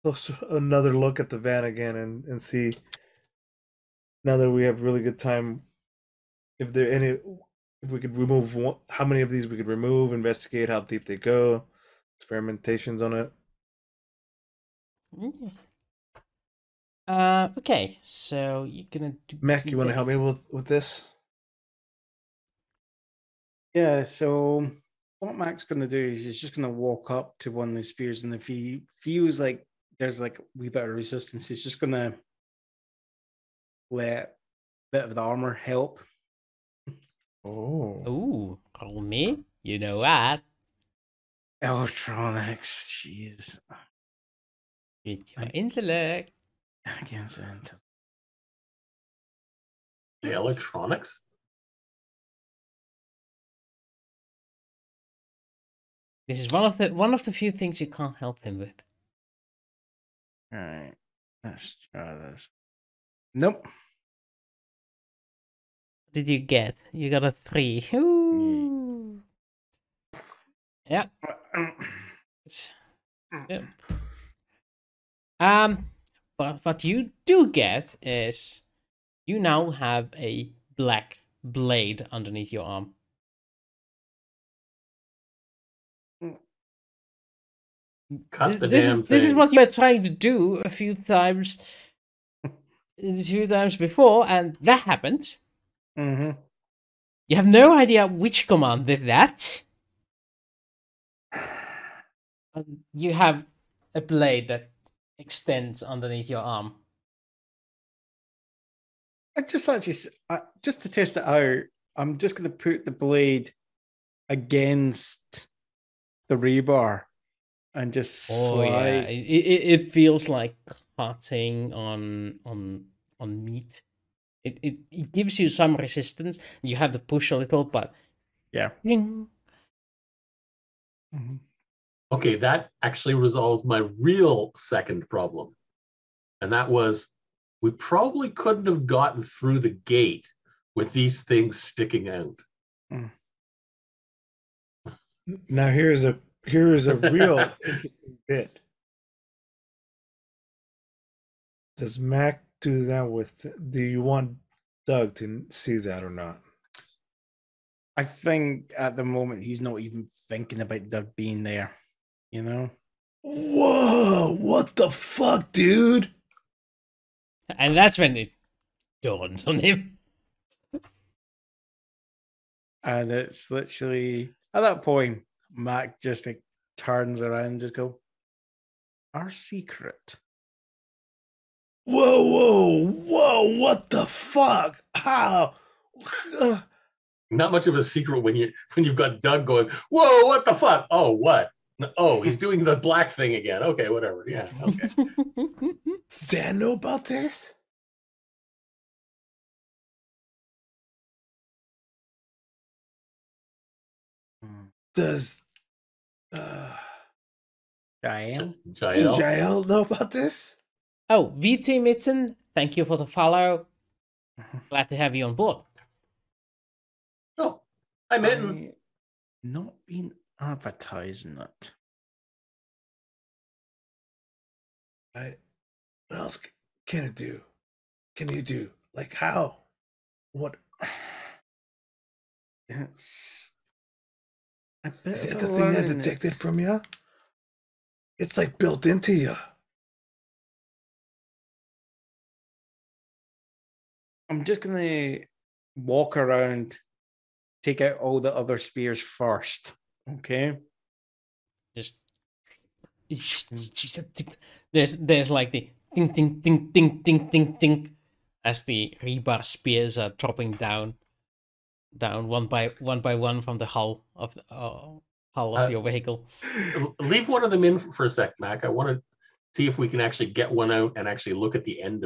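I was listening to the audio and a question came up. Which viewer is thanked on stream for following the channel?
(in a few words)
VT Mitten.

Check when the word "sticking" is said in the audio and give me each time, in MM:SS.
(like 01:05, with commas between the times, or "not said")
02:21.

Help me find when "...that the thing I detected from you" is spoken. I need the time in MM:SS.
03:55.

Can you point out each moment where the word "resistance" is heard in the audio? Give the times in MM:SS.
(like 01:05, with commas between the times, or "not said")
00:30, 02:05.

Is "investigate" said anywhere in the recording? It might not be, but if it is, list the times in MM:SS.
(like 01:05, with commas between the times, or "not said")
00:10.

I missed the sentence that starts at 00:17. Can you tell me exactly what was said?
Uh, okay, so you're gonna do.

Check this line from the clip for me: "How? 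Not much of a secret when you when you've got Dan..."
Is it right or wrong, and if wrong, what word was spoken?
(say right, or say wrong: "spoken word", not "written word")
wrong: "Doug", not "Dan".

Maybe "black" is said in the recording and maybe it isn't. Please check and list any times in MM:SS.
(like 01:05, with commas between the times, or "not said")
01:20, 03:12.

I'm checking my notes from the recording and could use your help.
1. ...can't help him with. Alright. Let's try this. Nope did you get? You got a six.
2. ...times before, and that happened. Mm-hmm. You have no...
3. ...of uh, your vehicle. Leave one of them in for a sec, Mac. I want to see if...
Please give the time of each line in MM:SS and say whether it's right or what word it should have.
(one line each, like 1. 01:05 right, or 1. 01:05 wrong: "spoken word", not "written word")
1. 00:57 wrong: "three", not "six"
2. 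01:33 right
3. 04:25 right.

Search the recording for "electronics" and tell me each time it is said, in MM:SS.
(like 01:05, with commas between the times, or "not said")
00:41, 00:50.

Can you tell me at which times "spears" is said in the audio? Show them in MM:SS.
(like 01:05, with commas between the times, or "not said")
00:27, 04:08, 04:19.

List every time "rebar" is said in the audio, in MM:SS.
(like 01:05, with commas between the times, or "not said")
01:56, 04:19.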